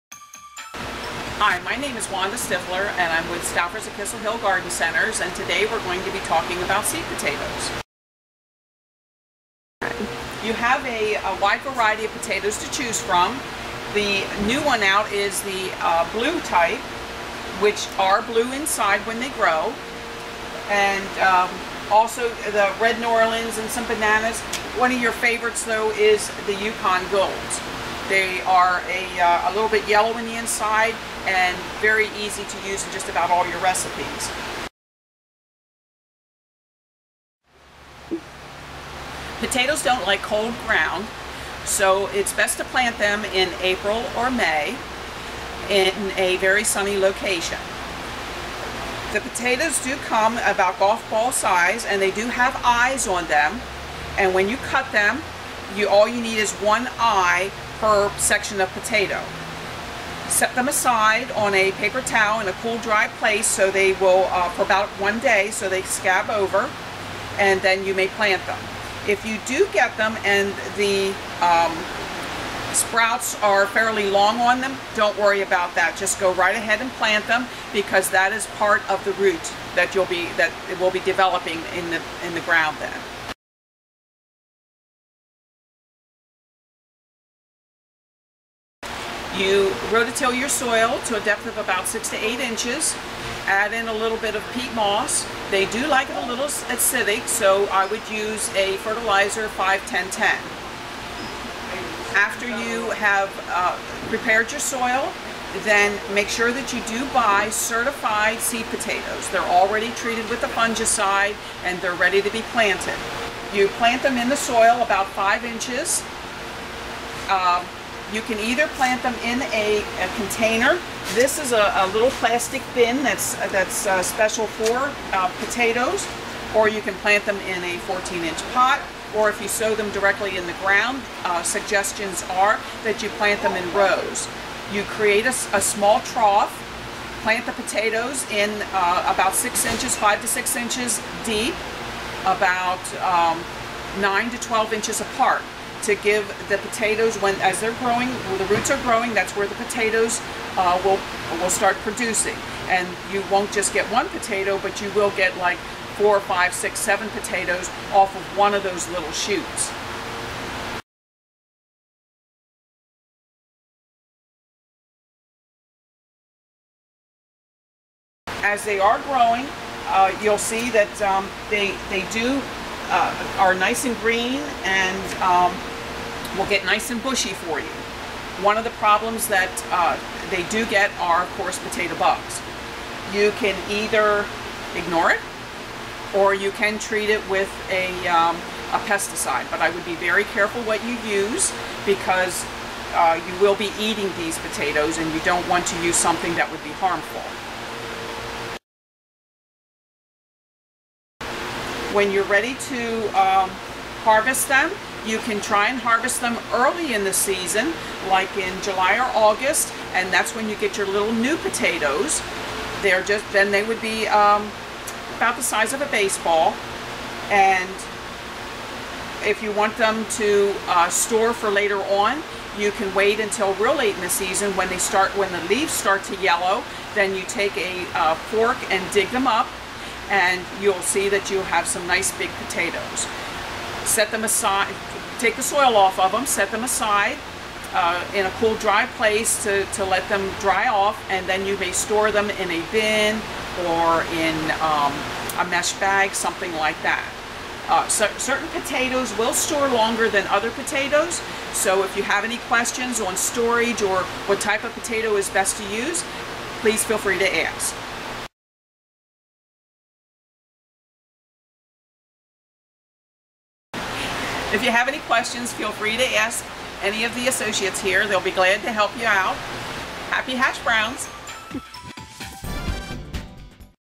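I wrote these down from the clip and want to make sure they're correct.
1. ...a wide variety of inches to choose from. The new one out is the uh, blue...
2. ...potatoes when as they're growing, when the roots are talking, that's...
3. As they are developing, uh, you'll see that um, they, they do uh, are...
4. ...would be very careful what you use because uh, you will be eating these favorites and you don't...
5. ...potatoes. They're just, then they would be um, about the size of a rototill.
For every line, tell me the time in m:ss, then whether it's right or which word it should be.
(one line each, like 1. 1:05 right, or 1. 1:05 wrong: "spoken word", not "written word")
1. 0:11 wrong: "potatoes", not "inches"
2. 2:26 wrong: "growing", not "talking"
3. 2:48 wrong: "growing", not "developing"
4. 3:09 wrong: "potatoes", not "favorites"
5. 3:31 wrong: "baseball", not "rototill".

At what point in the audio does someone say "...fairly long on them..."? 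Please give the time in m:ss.
1:13.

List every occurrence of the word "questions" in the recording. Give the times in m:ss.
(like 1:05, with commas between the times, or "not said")
4:12, 4:24.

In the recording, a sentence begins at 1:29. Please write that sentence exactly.
You rototill your soil to a depth of about six to eight inches.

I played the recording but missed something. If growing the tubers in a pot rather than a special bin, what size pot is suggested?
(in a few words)
14-inch.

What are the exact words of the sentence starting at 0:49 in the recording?
The potatoes do come about golf ball size and they do have eyes on them.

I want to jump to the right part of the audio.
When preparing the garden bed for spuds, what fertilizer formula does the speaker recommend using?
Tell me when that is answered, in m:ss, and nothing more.
1:39.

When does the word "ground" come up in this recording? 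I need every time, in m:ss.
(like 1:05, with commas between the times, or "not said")
0:40, 1:22, 2:10.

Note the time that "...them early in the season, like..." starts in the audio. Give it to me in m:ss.
3:26.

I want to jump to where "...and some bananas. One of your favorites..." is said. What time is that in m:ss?
0:23.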